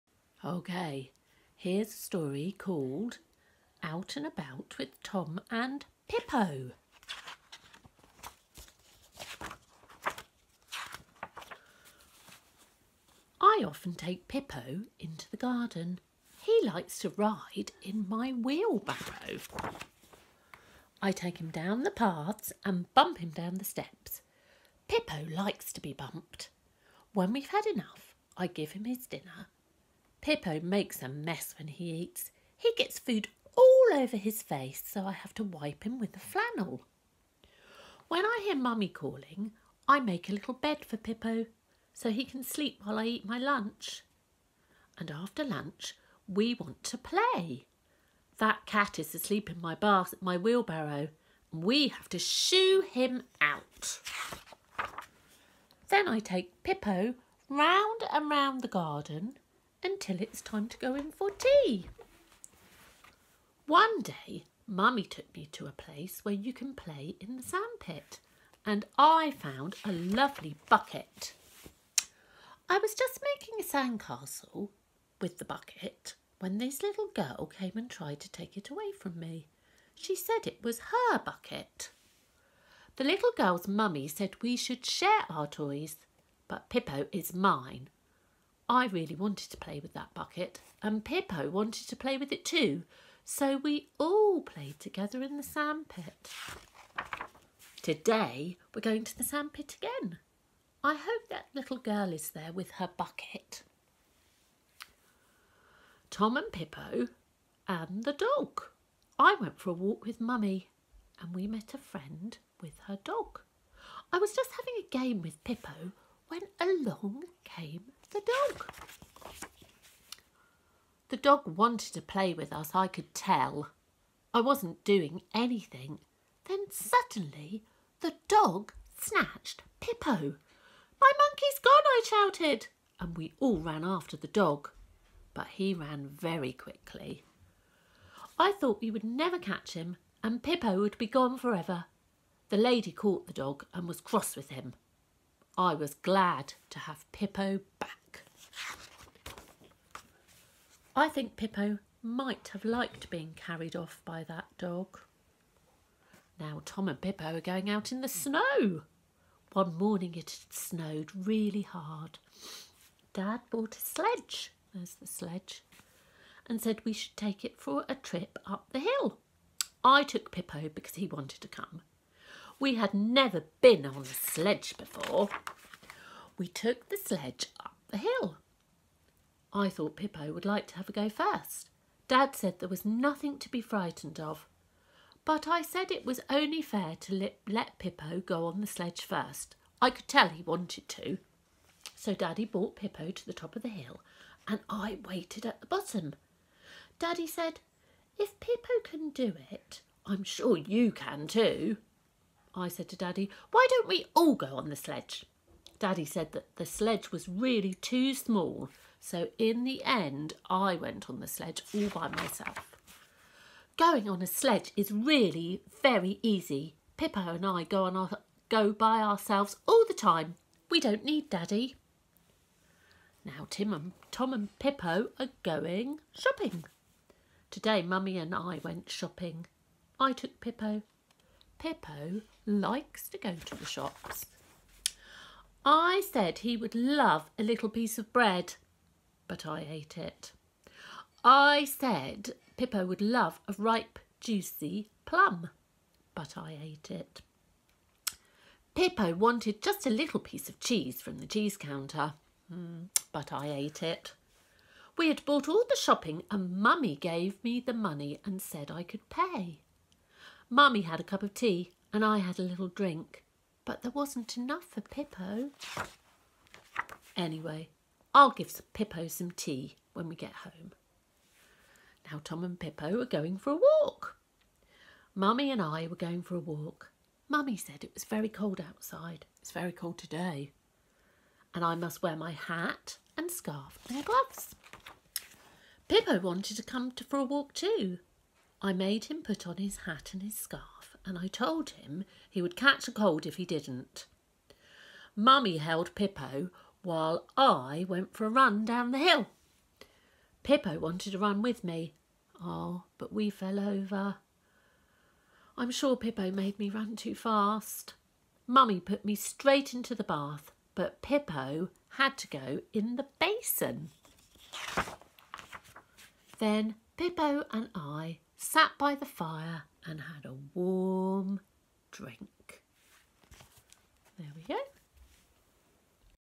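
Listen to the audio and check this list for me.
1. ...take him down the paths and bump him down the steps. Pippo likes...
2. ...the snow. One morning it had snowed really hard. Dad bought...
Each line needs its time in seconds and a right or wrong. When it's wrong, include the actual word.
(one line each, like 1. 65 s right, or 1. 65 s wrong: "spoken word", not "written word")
1. 21 s right
2. 158 s right.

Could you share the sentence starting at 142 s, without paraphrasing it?
The lady caught the dog and was cross with him.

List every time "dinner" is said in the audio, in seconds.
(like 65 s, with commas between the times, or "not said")
29 s.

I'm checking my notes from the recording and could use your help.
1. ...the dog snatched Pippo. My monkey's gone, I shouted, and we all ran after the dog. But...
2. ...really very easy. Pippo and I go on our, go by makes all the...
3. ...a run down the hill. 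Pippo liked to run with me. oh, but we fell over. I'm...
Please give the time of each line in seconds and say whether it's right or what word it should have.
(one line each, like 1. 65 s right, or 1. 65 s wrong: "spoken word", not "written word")
1. 128 s right
2. 214 s wrong: "ourselves", not "makes"
3. 298 s wrong: "wanted", not "liked".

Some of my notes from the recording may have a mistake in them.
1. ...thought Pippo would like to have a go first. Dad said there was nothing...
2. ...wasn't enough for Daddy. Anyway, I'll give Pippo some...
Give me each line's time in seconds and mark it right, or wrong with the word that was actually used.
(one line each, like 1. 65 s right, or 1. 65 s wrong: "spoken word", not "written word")
1. 179 s right
2. 263 s wrong: "Pippo", not "Daddy".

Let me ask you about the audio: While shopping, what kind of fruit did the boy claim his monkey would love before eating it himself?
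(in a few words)
plum.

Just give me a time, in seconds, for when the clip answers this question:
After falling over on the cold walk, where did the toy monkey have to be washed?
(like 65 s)
312 s.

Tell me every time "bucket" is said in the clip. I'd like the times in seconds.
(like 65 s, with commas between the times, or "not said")
70 s, 75 s, 81 s, 90 s, 102 s.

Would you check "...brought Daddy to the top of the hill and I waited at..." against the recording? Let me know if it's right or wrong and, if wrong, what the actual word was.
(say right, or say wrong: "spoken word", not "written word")
wrong: "Pippo", not "Daddy".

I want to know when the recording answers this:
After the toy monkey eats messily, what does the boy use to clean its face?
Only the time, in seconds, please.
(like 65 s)
36 s.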